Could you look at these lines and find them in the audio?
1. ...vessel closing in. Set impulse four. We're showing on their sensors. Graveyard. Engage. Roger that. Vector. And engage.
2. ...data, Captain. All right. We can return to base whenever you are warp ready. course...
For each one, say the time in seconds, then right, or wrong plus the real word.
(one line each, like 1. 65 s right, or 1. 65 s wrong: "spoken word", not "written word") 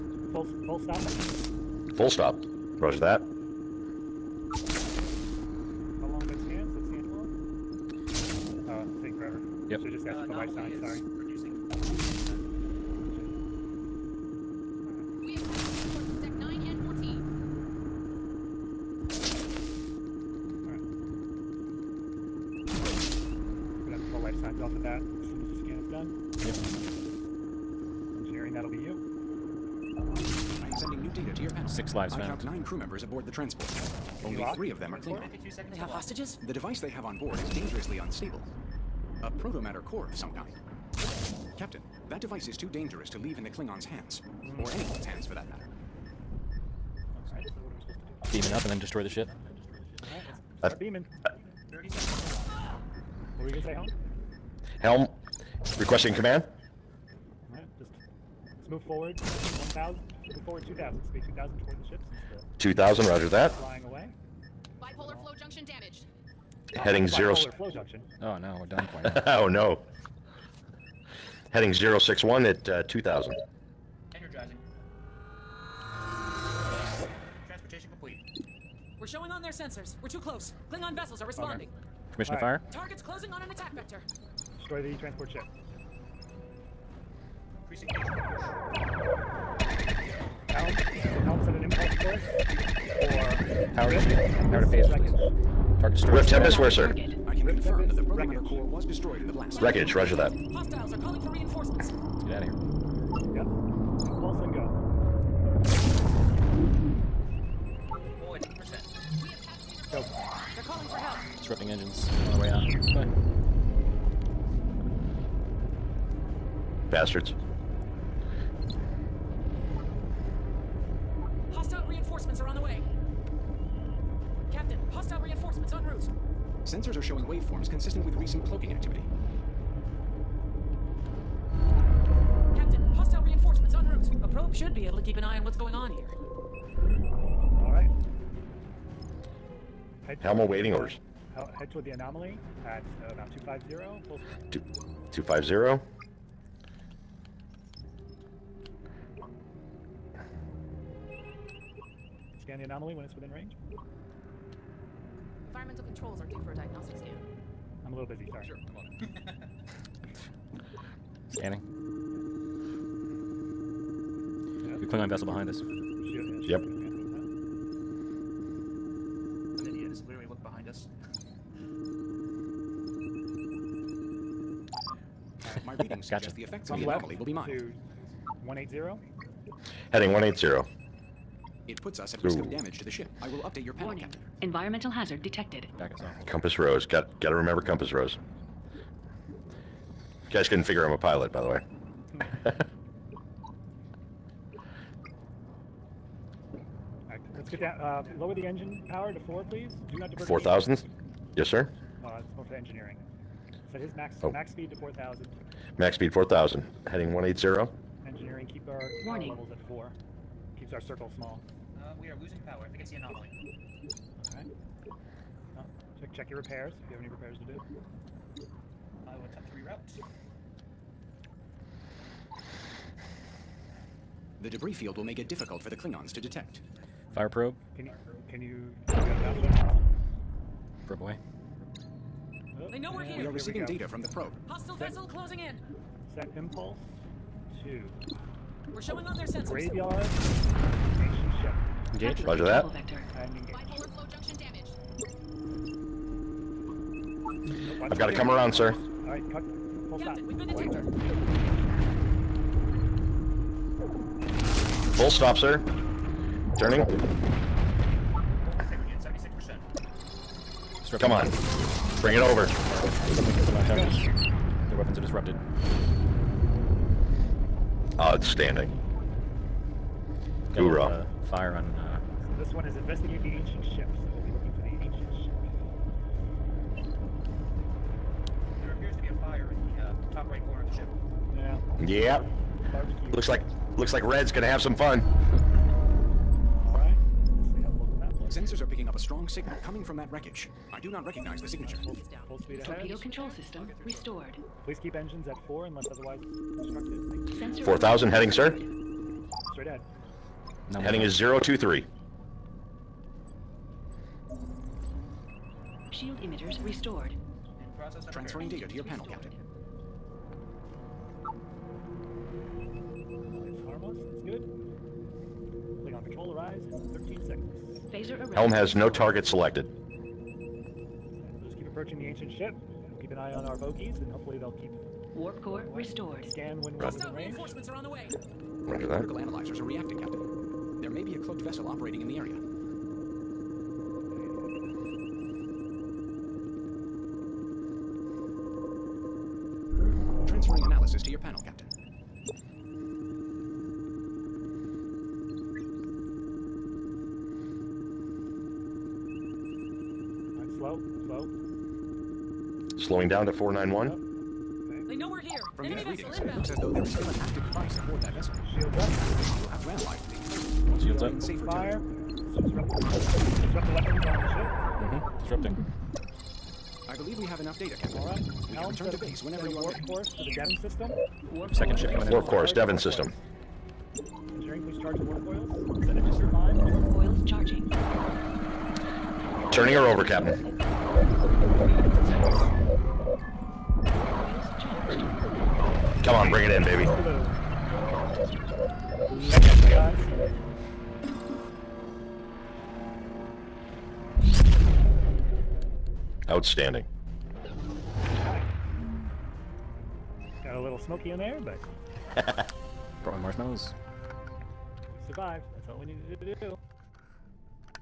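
1. 234 s wrong: "two", not "four"
2. 367 s right.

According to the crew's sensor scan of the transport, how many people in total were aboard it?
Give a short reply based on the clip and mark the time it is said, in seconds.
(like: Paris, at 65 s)
9, at 32 s.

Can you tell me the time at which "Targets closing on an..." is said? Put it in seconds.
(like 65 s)
82 s.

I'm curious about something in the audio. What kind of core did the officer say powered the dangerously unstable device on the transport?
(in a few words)
Protomatter core.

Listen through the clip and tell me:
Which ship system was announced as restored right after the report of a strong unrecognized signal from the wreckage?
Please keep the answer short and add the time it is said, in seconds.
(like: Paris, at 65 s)
Torpedo control system, at 292 s.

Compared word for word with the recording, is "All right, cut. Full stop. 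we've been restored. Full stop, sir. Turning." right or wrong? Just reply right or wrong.
wrong.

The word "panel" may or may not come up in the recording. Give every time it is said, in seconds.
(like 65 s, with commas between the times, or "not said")
31 s, 183 s, 308 s, 341 s.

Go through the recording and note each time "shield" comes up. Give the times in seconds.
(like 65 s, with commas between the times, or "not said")
93 s, 305 s, 358 s.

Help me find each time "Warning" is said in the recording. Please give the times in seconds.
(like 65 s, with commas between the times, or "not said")
183 s, 209 s.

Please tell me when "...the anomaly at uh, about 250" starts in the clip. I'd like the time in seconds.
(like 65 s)
141 s.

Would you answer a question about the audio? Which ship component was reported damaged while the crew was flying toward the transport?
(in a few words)
Bipolar flow junction.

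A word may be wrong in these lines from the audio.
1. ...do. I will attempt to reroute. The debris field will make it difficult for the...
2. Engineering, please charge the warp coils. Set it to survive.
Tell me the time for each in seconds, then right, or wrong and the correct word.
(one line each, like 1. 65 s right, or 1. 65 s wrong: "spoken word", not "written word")
1. 217 s right
2. 374 s right.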